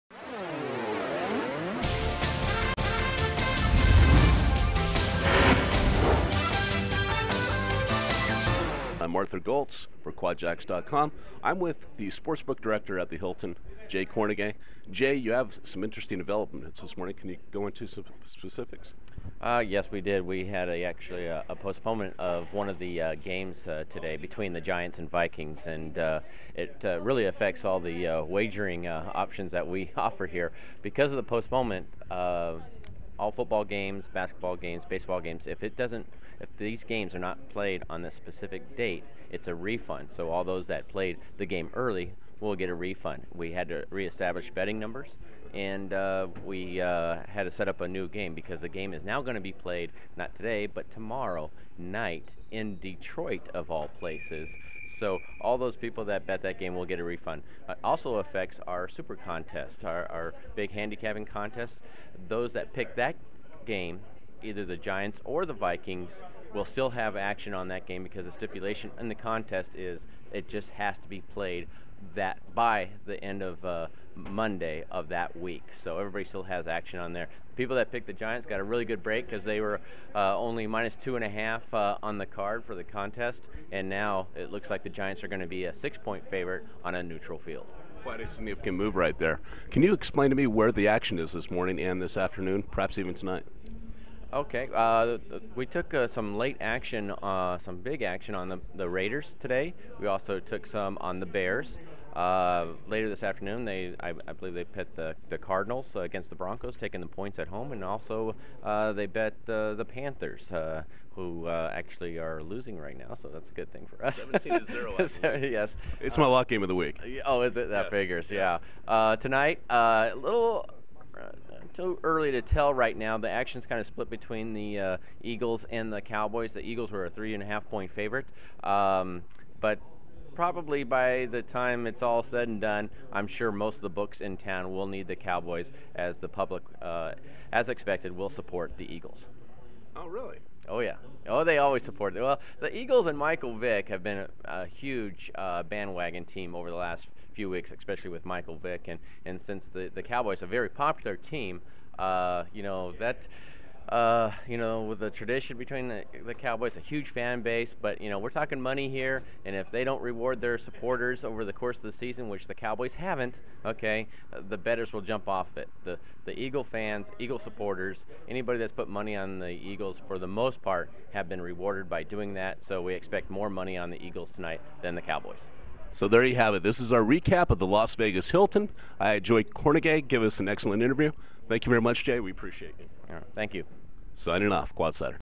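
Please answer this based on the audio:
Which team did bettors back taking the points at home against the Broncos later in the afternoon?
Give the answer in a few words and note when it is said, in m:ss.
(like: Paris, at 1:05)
Cardinals, at 1:45.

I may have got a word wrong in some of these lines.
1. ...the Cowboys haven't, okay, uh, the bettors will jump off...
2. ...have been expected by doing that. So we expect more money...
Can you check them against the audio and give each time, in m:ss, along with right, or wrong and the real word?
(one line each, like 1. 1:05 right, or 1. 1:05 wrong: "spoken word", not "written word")
1. 2:42 right
2. 2:51 wrong: "rewarded", not "expected".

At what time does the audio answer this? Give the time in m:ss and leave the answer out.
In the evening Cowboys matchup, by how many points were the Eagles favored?
2:07.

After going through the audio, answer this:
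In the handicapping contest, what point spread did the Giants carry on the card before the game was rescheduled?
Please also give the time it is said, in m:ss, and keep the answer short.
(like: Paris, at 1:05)
-2.5, at 1:20.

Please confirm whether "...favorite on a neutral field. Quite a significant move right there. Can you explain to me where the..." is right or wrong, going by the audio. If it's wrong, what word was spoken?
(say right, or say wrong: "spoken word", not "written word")
right.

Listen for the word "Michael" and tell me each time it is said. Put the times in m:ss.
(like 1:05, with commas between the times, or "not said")
2:23, 2:28.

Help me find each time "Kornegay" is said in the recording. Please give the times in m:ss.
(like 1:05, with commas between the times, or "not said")
0:14, 2:59.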